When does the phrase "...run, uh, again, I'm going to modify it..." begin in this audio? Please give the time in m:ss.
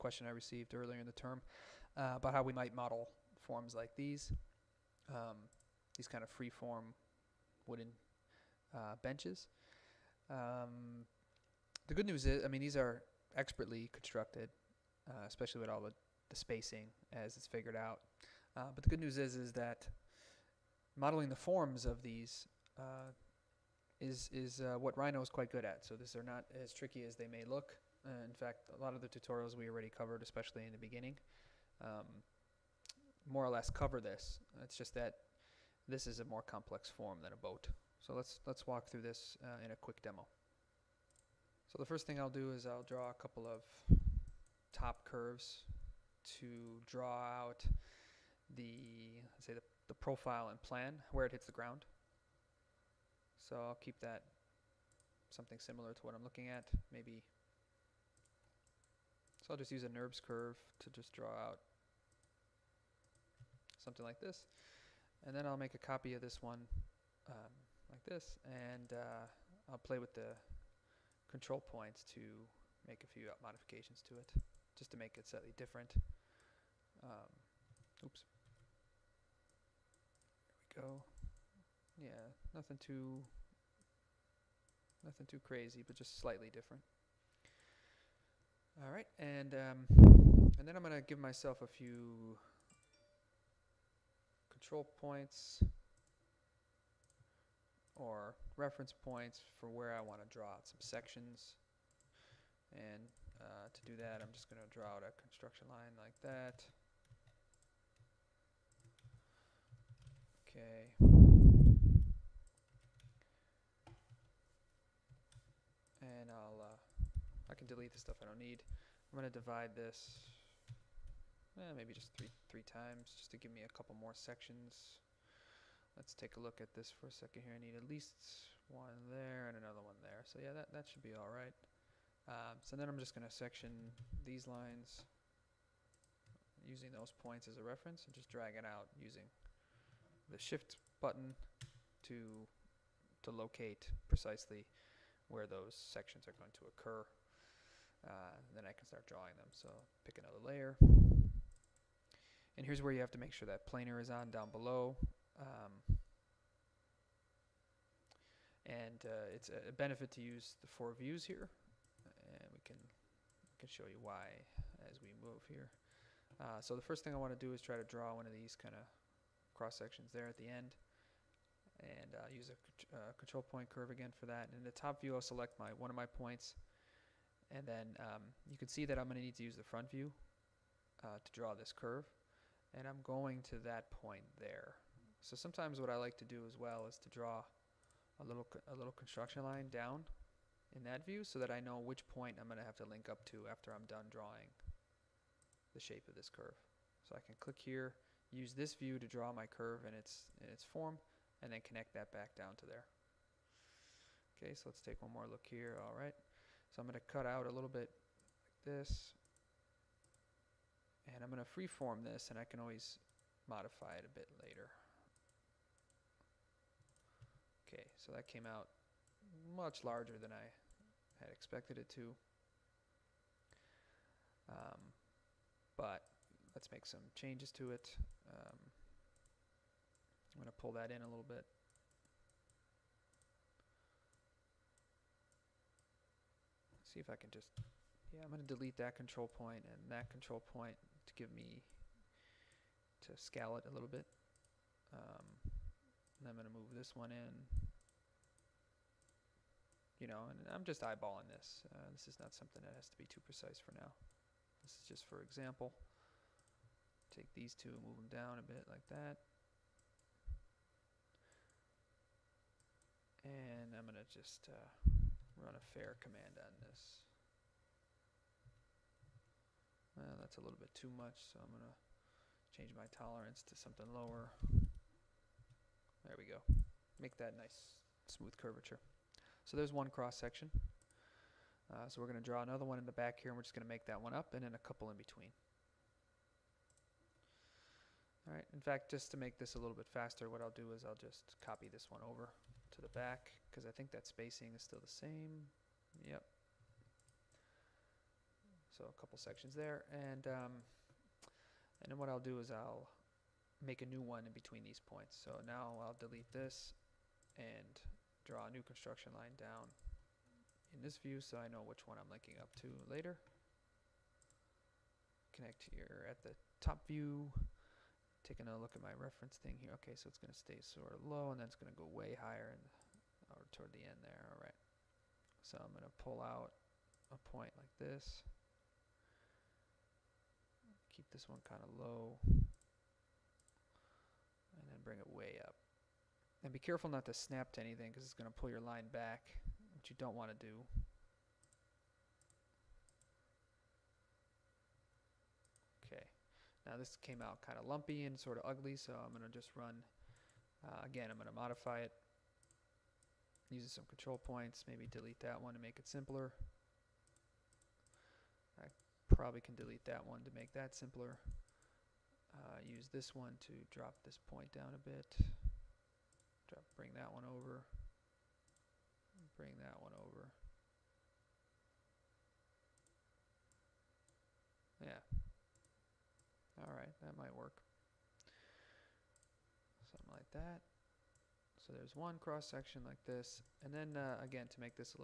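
5:49.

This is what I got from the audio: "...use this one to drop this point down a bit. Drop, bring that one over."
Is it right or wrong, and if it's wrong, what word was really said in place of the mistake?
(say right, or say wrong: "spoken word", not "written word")
right.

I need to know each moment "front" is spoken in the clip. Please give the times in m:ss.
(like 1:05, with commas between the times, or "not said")
2:59.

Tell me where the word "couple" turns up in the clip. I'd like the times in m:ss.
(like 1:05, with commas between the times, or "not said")
0:43, 2:03, 4:44, 4:59.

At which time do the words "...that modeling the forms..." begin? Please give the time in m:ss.
0:19.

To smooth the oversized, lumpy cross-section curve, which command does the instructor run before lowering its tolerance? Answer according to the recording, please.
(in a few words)
Fair.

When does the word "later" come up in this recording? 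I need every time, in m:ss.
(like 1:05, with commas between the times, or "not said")
3:34, 5:12.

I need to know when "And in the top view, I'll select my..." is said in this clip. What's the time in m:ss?
2:54.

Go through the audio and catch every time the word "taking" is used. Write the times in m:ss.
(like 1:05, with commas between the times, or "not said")
5:18.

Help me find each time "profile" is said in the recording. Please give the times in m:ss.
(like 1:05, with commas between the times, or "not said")
0:49.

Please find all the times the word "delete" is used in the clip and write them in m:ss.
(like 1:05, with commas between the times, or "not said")
1:57, 3:58, 5:05, 5:54, 5:59.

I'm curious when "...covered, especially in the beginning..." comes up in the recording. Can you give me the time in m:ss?
0:29.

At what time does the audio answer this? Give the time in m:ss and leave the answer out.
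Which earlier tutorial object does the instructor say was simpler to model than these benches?
0:37.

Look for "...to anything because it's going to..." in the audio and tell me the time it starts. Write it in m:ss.
5:37.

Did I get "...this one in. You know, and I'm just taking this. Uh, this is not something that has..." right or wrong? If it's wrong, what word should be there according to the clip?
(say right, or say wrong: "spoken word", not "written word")
wrong: "eyeballing", not "taking".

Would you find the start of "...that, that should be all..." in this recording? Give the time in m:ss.
2:10.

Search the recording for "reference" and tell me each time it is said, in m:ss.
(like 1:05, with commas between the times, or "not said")
1:38, 2:17, 5:18.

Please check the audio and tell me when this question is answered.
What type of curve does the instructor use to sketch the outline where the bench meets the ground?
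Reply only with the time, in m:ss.
0:59.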